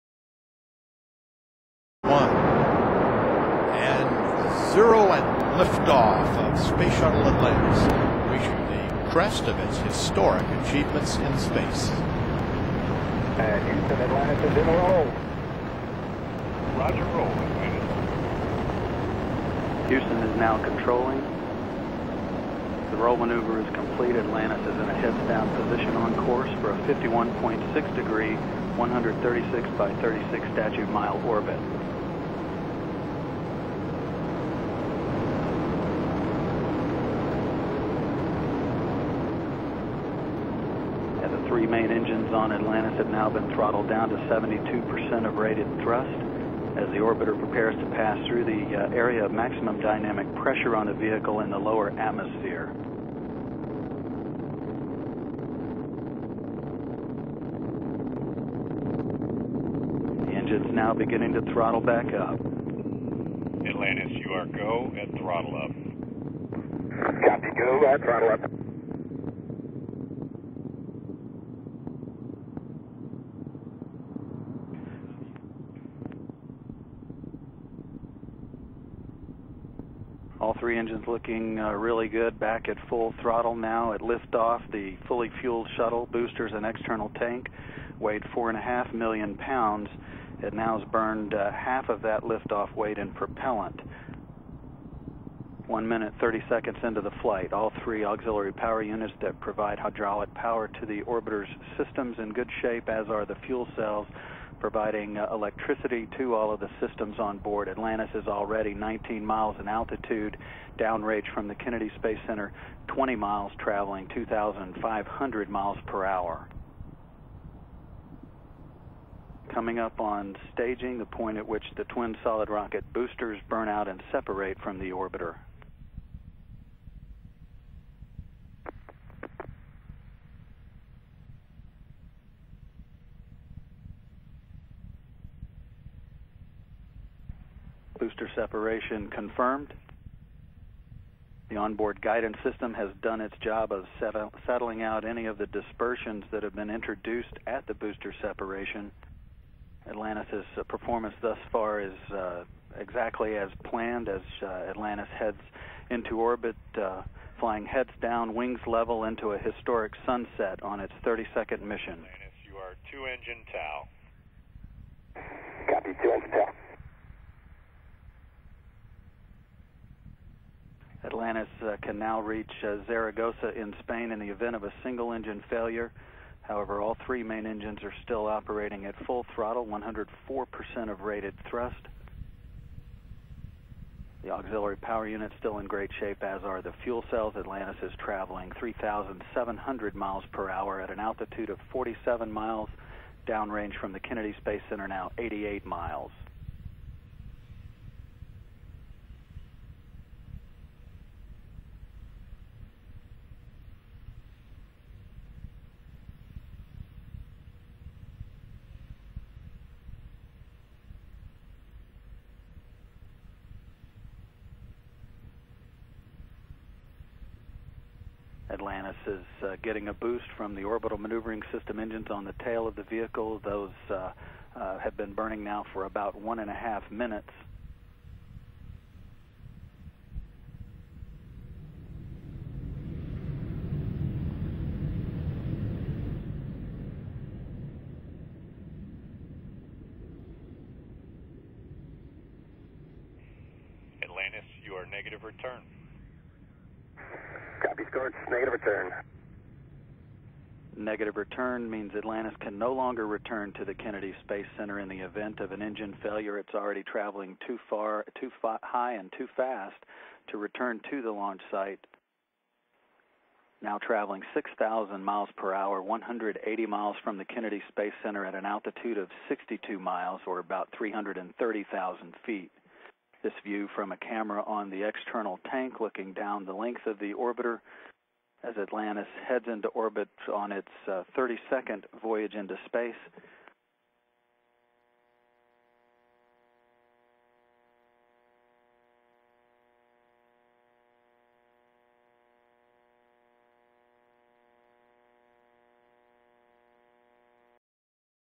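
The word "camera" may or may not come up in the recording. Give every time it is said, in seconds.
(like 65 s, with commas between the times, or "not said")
273 s.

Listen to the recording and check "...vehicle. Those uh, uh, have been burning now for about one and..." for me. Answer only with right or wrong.
right.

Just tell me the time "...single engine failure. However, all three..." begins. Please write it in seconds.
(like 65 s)
174 s.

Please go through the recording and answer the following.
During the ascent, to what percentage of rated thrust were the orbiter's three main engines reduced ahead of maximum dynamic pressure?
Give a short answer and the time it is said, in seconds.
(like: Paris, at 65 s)
72%, at 44 s.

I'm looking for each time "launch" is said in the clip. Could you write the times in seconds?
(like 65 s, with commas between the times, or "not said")
261 s.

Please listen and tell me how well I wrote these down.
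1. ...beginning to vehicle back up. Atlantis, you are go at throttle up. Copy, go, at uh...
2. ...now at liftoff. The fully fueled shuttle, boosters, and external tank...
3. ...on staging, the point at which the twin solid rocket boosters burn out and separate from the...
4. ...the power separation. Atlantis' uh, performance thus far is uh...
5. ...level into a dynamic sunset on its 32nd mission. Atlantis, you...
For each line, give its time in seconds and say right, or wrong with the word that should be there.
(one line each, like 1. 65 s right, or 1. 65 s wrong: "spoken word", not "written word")
1. 60 s wrong: "throttle", not "vehicle"
2. 83 s right
3. 119 s right
4. 147 s wrong: "booster", not "power"
5. 158 s wrong: "historic", not "dynamic".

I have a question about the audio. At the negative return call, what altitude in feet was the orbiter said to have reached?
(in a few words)
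330,000 feet.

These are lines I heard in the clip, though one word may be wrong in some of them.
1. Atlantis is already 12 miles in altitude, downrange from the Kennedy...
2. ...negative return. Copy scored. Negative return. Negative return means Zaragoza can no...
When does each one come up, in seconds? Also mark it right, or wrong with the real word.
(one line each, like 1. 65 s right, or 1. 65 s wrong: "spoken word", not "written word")
1. 107 s wrong: "19", not "12"
2. 244 s wrong: "Atlantis", not "Zaragoza".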